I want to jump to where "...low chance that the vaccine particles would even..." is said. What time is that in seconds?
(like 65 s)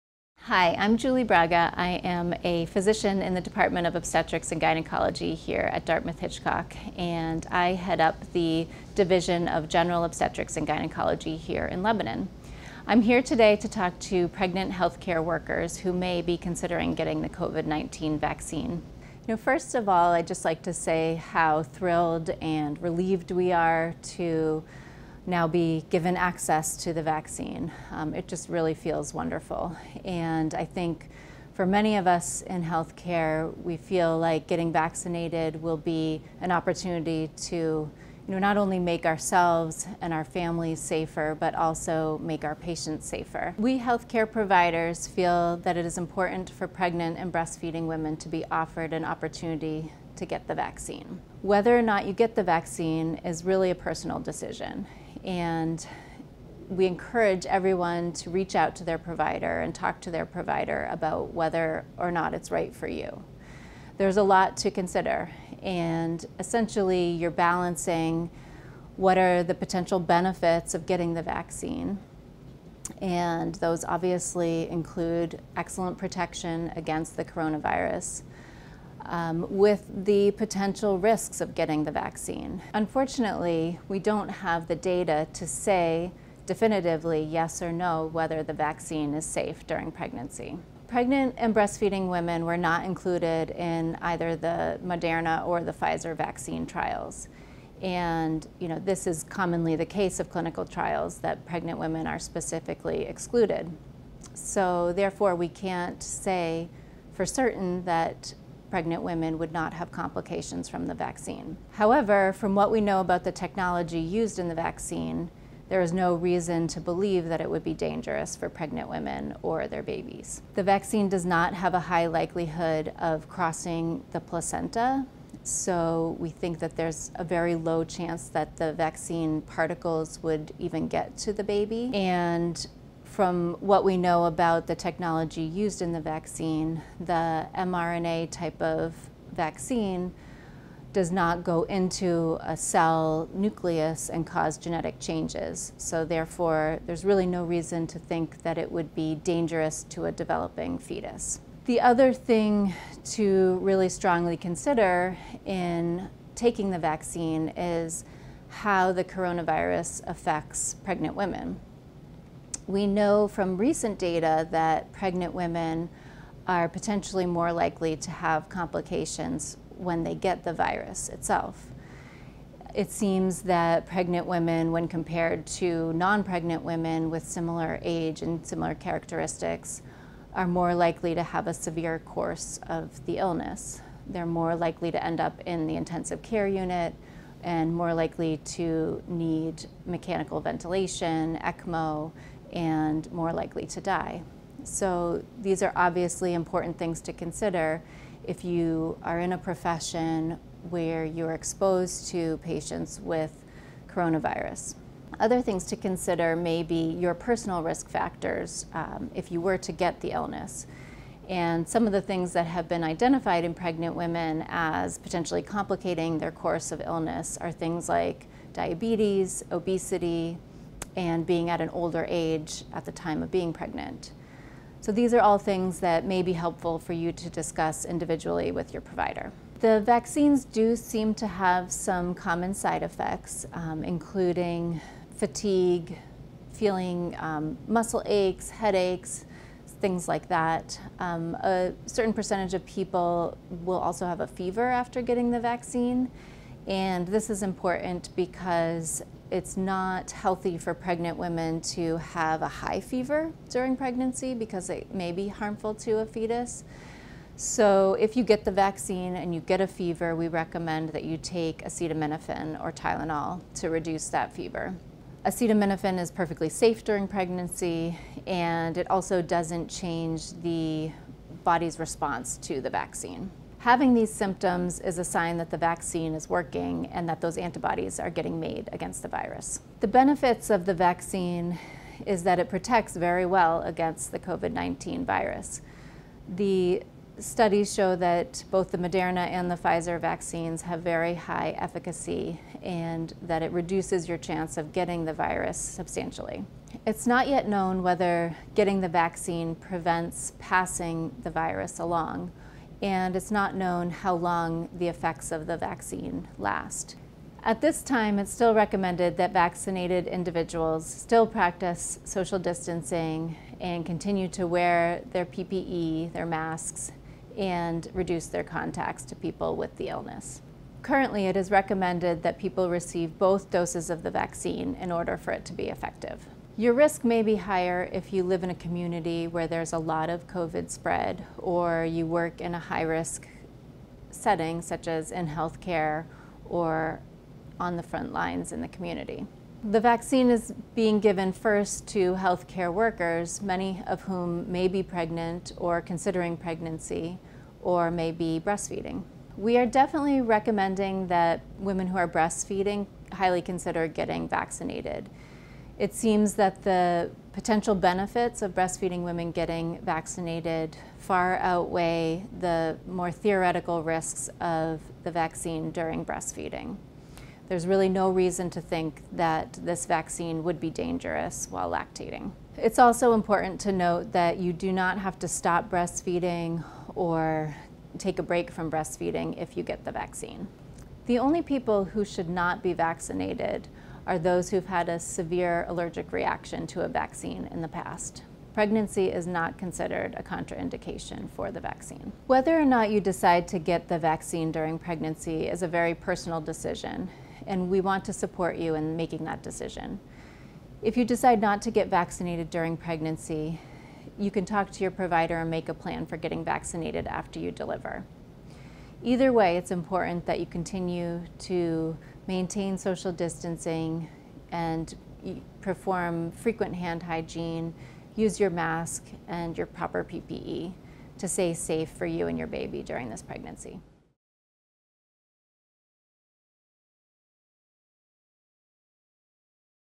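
127 s.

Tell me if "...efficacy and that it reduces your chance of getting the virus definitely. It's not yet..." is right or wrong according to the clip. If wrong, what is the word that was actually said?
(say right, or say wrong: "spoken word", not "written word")
wrong: "substantially", not "definitely".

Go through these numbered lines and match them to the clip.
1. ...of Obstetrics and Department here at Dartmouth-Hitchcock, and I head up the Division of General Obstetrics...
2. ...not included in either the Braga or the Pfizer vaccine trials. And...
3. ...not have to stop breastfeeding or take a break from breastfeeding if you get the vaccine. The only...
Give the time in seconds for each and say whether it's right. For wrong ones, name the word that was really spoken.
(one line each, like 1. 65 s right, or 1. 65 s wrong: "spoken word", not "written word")
1. 3 s wrong: "Gynecology", not "Department"
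2. 92 s wrong: "Moderna", not "Braga"
3. 374 s right.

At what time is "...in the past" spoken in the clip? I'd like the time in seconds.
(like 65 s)
387 s.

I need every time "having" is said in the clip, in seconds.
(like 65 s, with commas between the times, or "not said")
273 s.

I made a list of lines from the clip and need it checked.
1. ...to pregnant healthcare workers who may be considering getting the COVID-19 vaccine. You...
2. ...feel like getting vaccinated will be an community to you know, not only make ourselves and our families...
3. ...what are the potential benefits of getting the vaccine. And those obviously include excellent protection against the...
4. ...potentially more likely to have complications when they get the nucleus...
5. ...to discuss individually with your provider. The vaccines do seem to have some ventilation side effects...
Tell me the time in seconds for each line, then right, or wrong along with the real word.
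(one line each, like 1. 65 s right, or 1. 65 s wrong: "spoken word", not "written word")
1. 13 s right
2. 33 s wrong: "opportunity", not "community"
3. 68 s right
4. 166 s wrong: "virus", not "nucleus"
5. 227 s wrong: "common", not "ventilation".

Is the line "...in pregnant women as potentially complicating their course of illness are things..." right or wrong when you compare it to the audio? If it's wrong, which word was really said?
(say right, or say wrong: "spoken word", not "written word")
right.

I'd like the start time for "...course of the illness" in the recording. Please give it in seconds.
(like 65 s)
181 s.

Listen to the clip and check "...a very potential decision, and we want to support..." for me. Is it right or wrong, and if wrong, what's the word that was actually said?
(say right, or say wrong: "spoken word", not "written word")
wrong: "personal", not "potential".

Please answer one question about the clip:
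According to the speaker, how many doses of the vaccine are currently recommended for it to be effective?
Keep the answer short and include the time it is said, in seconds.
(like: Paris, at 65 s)
2, at 323 s.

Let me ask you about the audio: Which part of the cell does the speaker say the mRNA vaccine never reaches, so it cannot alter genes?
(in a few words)
cell nucleus.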